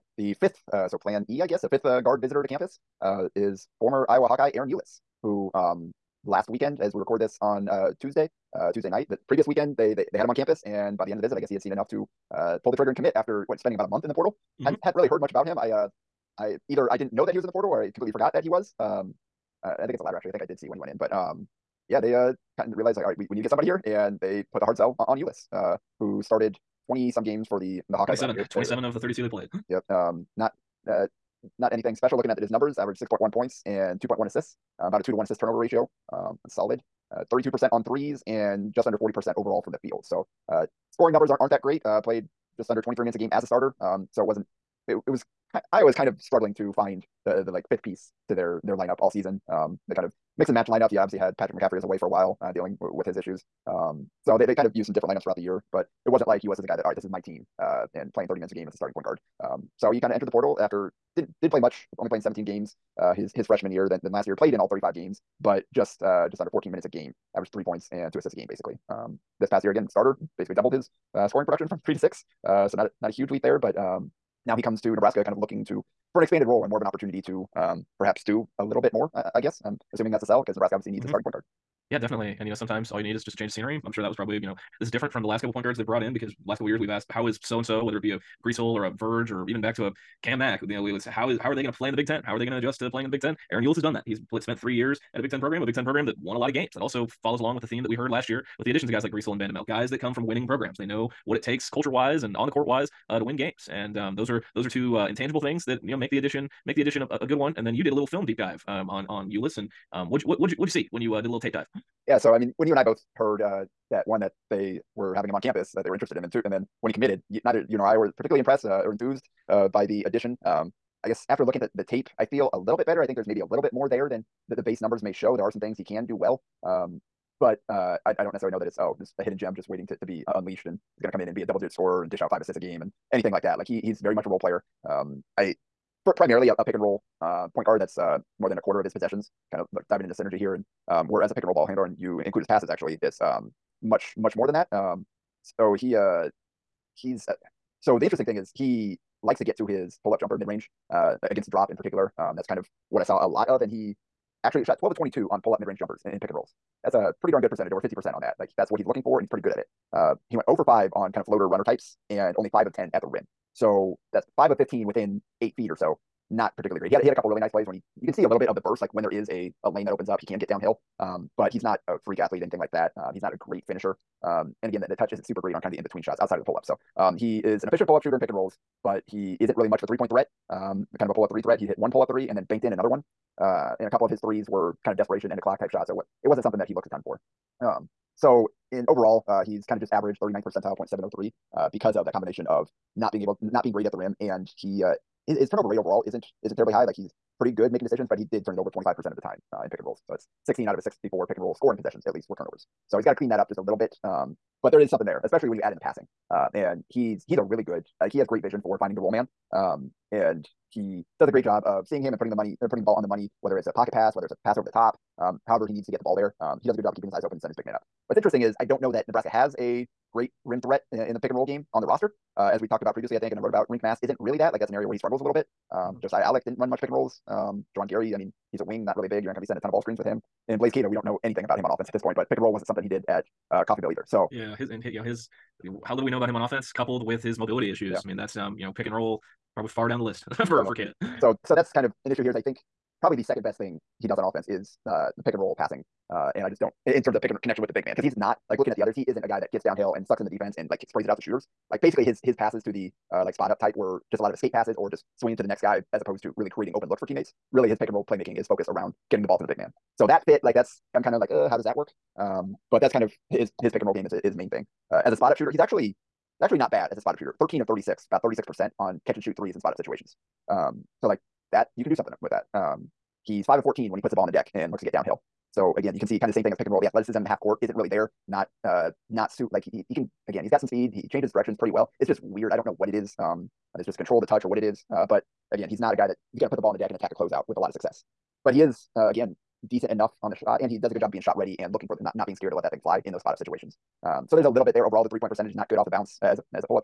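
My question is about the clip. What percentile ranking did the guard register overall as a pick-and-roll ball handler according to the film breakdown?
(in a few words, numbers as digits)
39th percentile.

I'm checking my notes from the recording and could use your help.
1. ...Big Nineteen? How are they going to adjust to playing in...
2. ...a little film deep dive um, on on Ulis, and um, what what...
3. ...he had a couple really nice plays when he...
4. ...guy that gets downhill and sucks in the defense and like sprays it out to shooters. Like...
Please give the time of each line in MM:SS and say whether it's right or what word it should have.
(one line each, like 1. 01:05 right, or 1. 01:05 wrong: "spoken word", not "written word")
1. 01:31 wrong: "Ten", not "Nineteen"
2. 01:47 right
3. 02:47 right
4. 04:09 right.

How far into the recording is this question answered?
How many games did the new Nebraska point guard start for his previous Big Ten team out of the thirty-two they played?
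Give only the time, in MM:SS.
00:28.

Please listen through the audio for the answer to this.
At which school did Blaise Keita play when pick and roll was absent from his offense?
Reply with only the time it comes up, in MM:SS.
03:53.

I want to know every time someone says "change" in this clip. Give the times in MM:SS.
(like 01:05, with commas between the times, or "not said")
01:23, 04:41.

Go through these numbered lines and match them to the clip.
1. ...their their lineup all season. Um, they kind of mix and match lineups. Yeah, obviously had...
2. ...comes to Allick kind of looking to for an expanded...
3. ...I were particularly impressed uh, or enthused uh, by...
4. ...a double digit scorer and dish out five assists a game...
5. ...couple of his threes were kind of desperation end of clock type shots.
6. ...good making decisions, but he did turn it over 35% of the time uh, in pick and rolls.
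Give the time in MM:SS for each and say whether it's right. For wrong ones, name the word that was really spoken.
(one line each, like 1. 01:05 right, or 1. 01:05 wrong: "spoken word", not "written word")
1. 00:48 right
2. 01:14 wrong: "Nebraska", not "Allick"
3. 01:57 right
4. 02:11 right
5. 03:03 right
6. 03:17 wrong: "25", not "35".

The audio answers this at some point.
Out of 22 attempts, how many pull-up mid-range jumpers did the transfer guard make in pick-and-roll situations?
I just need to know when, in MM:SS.
02:34.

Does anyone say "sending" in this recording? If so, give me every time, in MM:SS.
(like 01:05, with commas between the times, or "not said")
03:37, 03:49.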